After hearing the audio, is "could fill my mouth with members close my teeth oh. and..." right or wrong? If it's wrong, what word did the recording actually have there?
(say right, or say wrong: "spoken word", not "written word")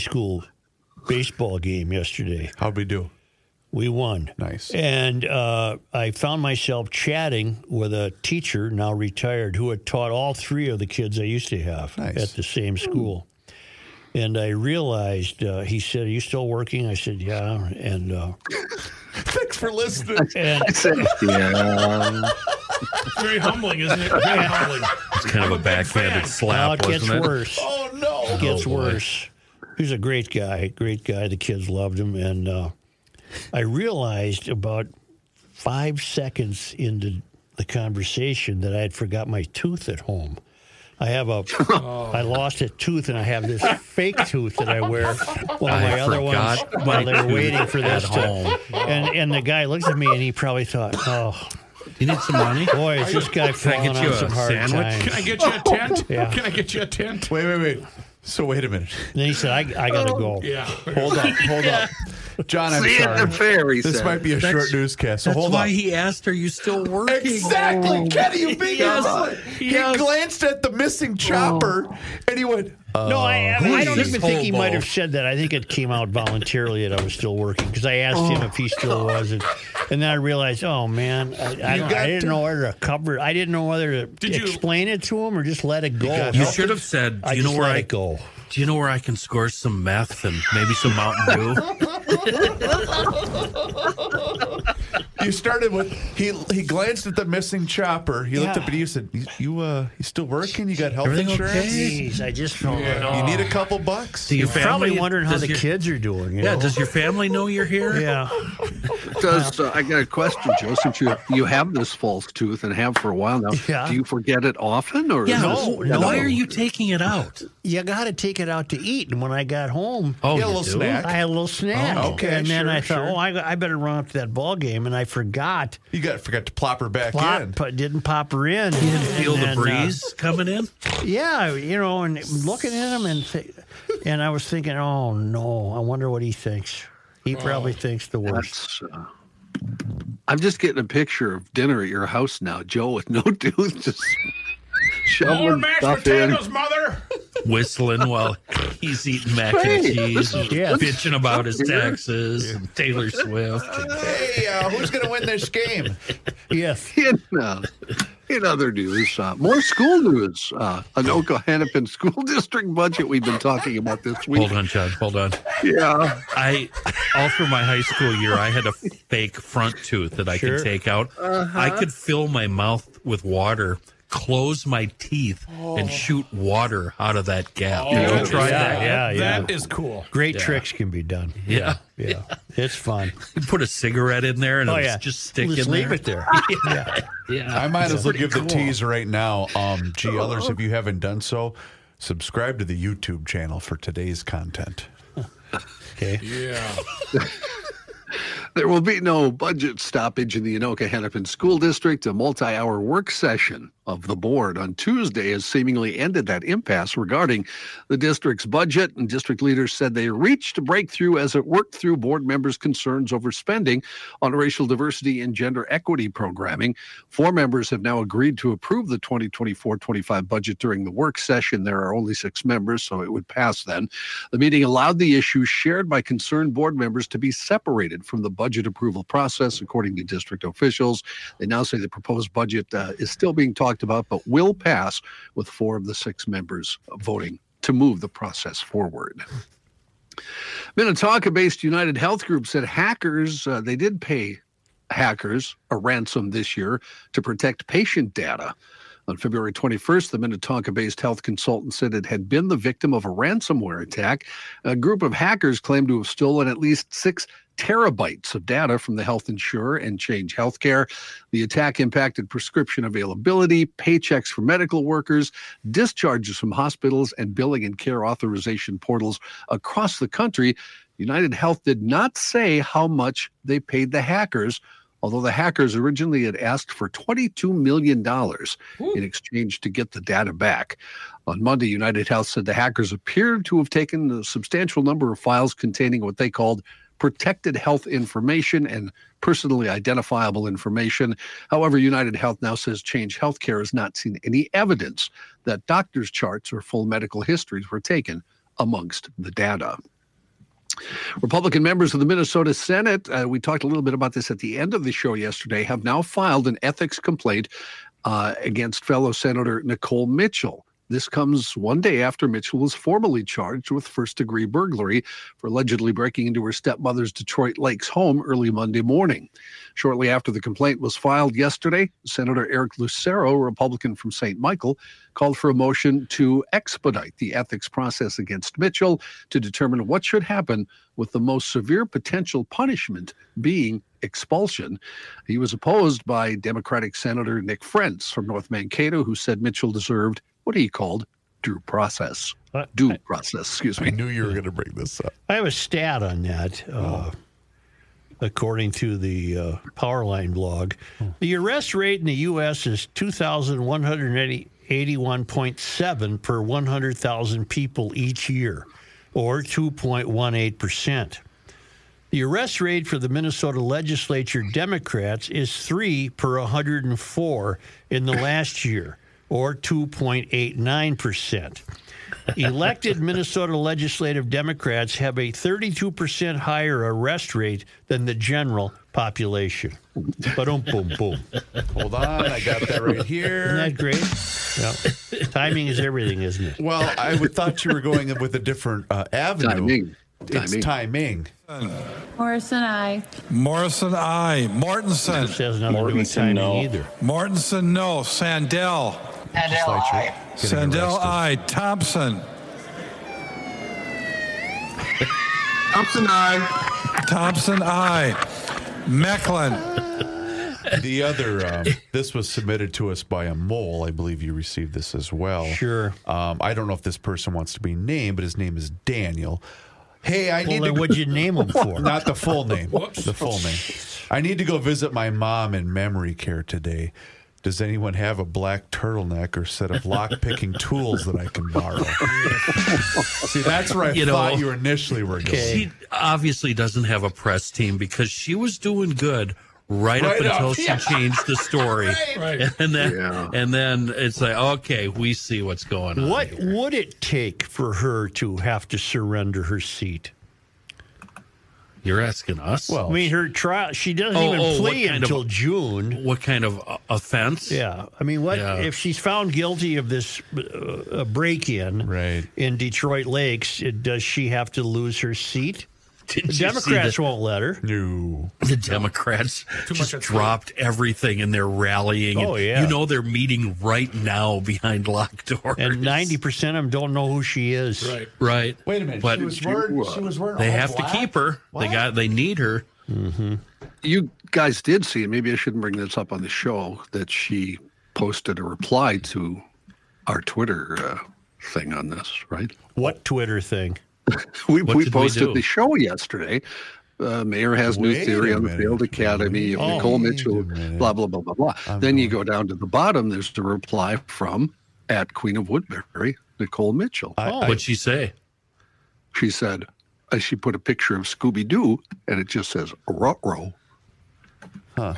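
wrong: "water", not "members".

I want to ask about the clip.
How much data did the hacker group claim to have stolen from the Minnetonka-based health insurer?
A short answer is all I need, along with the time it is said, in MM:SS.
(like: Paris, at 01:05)
6 terabytes, at 04:16.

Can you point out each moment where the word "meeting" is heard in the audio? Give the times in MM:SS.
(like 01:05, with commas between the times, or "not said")
03:44, 07:53.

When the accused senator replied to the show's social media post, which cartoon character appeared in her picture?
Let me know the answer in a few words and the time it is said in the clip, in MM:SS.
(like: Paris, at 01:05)
Scooby Doo, at 08:31.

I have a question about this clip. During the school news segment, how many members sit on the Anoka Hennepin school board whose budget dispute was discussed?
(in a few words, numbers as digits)
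6.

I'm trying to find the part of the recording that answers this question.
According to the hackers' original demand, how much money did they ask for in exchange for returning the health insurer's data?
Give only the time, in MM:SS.
04:36.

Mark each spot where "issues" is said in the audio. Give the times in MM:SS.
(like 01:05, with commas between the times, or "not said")
03:45.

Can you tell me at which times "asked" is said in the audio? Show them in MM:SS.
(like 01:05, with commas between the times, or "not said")
01:05, 01:17, 04:36.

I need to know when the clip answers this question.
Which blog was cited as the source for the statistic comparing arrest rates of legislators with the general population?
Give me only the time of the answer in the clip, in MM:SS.
05:49.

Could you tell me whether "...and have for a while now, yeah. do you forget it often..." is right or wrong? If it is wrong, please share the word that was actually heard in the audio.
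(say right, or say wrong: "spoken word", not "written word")
right.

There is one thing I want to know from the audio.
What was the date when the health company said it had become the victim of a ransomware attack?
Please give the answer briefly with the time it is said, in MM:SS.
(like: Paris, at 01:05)
February 21st, at 04:09.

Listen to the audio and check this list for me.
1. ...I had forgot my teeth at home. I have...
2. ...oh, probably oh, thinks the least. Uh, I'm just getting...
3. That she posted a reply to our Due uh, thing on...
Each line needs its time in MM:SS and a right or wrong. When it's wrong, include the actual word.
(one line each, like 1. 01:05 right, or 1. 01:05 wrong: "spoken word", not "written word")
1. 00:38 wrong: "tooth", not "teeth"
2. 02:17 wrong: "worst", not "least"
3. 08:06 wrong: "Twitter", not "Due".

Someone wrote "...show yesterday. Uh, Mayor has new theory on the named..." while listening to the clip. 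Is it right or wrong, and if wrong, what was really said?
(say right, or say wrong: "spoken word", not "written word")
wrong: "failed", not "named".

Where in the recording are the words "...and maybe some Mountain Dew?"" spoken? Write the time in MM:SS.
01:30.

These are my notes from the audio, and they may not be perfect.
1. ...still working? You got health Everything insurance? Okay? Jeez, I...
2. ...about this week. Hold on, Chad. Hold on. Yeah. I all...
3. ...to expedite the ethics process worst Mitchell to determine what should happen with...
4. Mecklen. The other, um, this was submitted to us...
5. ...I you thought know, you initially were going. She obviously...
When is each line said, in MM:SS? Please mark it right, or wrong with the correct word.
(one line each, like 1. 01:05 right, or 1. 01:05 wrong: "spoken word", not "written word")
1. 01:40 right
2. 02:43 right
3. 05:26 wrong: "against", not "worst"
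4. 06:48 right
5. 07:13 right.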